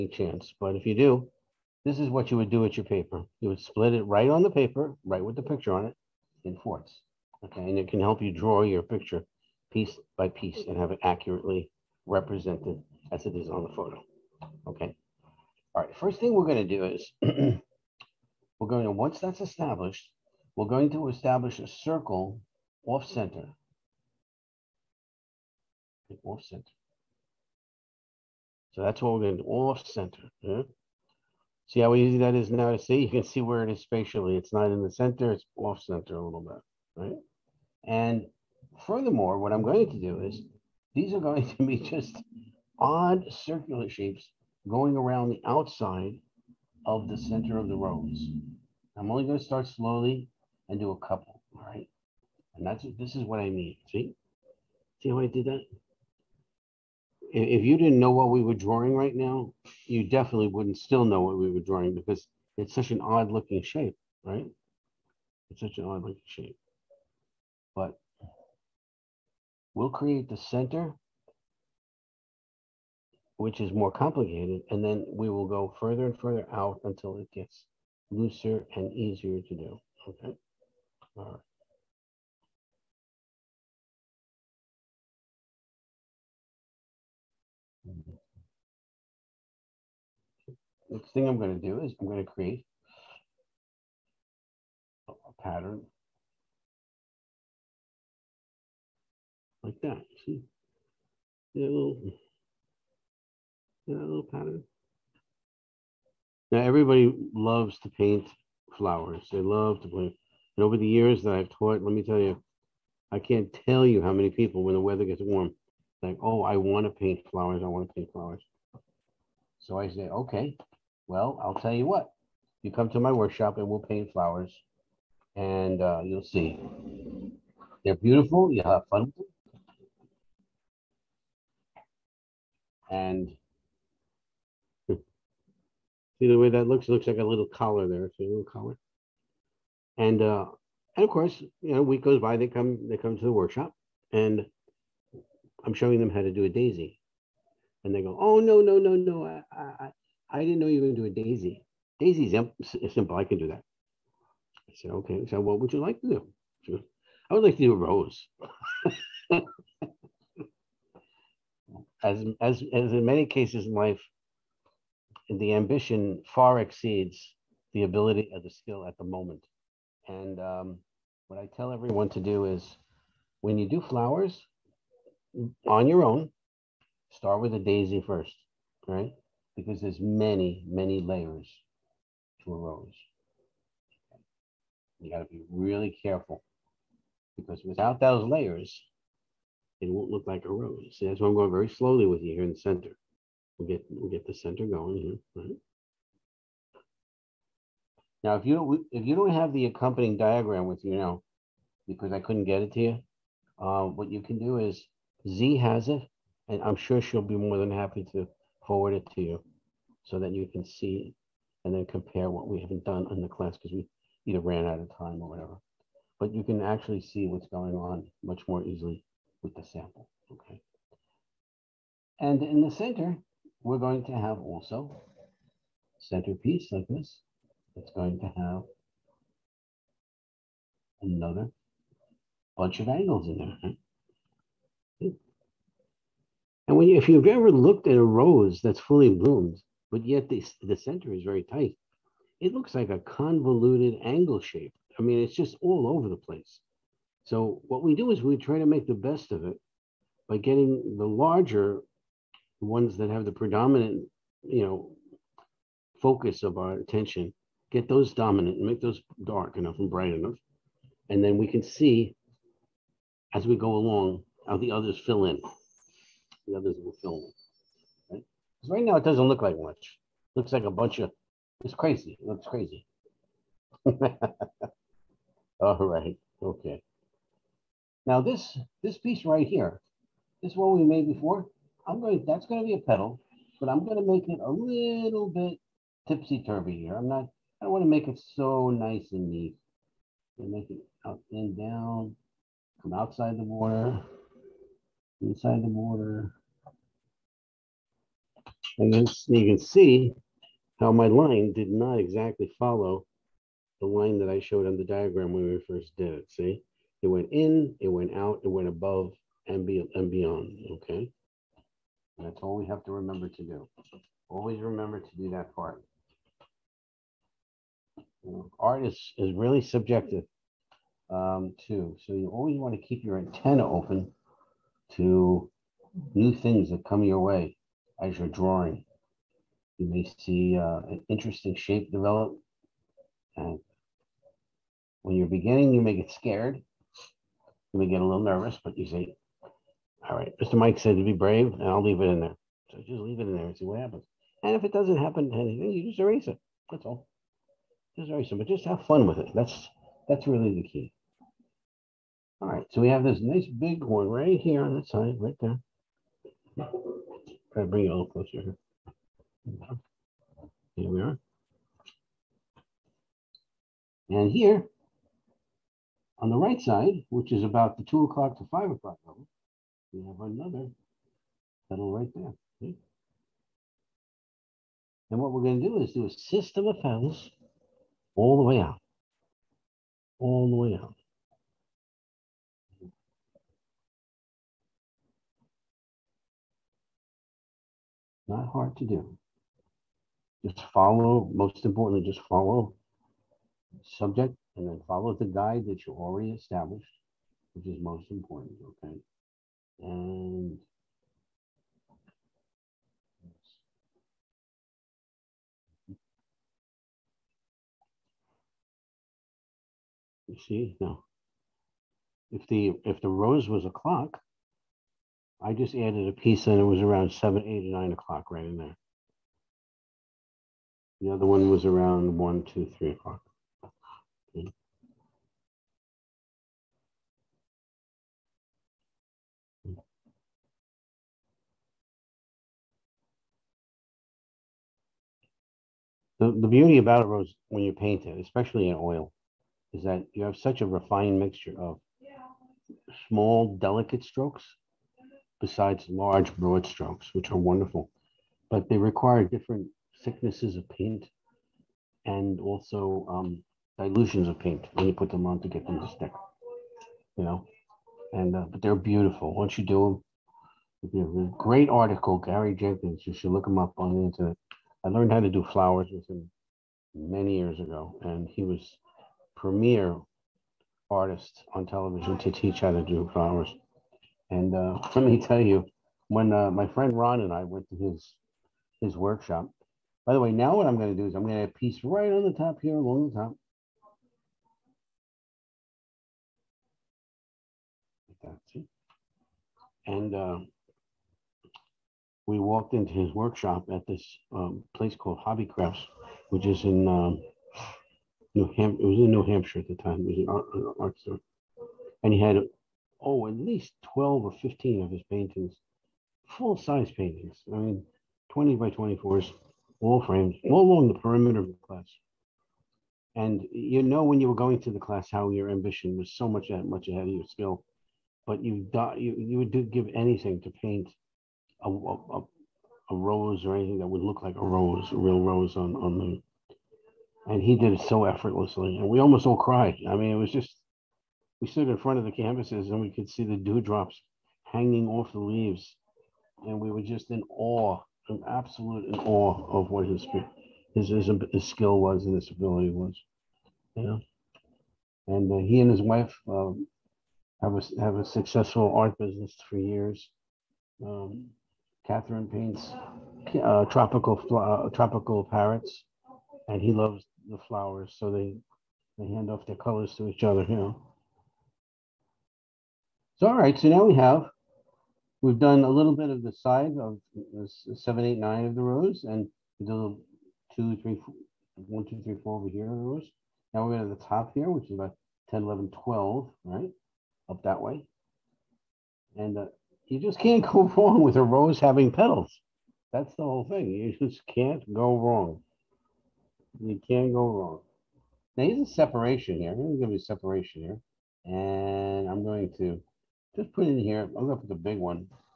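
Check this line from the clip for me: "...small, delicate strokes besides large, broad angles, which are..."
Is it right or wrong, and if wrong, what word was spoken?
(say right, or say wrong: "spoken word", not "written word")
wrong: "strokes", not "angles".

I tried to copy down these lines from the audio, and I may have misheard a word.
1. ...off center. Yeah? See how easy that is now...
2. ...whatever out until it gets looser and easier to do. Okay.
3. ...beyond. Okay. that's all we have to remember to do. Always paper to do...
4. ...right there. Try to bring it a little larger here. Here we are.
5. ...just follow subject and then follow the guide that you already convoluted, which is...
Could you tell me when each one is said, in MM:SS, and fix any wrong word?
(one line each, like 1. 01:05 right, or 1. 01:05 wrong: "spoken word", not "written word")
1. 00:29 right
2. 01:16 wrong: "further", not "whatever"
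3. 05:10 wrong: "remember", not "paper"
4. 05:55 wrong: "closer", not "larger"
5. 06:32 wrong: "established", not "convoluted".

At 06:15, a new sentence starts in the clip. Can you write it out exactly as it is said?
And what we're going to do is do a system of petals all the way out, all the way out.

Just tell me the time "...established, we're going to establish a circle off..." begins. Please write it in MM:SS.
00:19.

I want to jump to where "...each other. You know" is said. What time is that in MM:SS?
09:20.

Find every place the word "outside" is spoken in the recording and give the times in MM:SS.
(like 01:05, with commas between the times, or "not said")
00:45, 04:52.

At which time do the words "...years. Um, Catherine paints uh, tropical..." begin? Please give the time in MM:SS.
09:09.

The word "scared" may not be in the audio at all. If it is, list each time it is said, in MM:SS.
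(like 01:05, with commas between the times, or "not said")
05:36.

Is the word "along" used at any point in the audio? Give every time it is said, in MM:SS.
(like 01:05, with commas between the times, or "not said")
04:23, 08:02, 08:30.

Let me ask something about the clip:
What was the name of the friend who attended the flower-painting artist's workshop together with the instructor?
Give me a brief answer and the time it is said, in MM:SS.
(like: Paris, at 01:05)
Ron, at 07:56.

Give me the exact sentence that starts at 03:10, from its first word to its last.
See, that's why I'm going very slowly with you here in the center.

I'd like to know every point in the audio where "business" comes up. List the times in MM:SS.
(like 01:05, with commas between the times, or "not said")
09:08.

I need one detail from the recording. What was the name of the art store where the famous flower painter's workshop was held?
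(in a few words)
Hobby Crafts.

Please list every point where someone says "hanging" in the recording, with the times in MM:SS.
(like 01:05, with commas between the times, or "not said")
08:54.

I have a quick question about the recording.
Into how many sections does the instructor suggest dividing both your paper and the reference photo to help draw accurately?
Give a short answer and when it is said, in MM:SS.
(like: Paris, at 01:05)
4, at 00:06.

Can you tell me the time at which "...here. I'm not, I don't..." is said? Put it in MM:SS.
04:46.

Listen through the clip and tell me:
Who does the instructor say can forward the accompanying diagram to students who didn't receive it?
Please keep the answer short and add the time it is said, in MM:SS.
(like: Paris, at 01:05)
Z, at 03:25.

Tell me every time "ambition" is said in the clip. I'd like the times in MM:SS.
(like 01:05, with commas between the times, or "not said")
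02:45, 08:35.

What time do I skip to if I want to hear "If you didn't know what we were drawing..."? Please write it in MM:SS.
00:57.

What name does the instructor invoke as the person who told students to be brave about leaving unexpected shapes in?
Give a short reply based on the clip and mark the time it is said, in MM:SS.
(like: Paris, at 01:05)
Mr. Mike, at 05:40.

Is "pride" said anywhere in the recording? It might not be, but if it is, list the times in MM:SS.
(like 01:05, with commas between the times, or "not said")
not said.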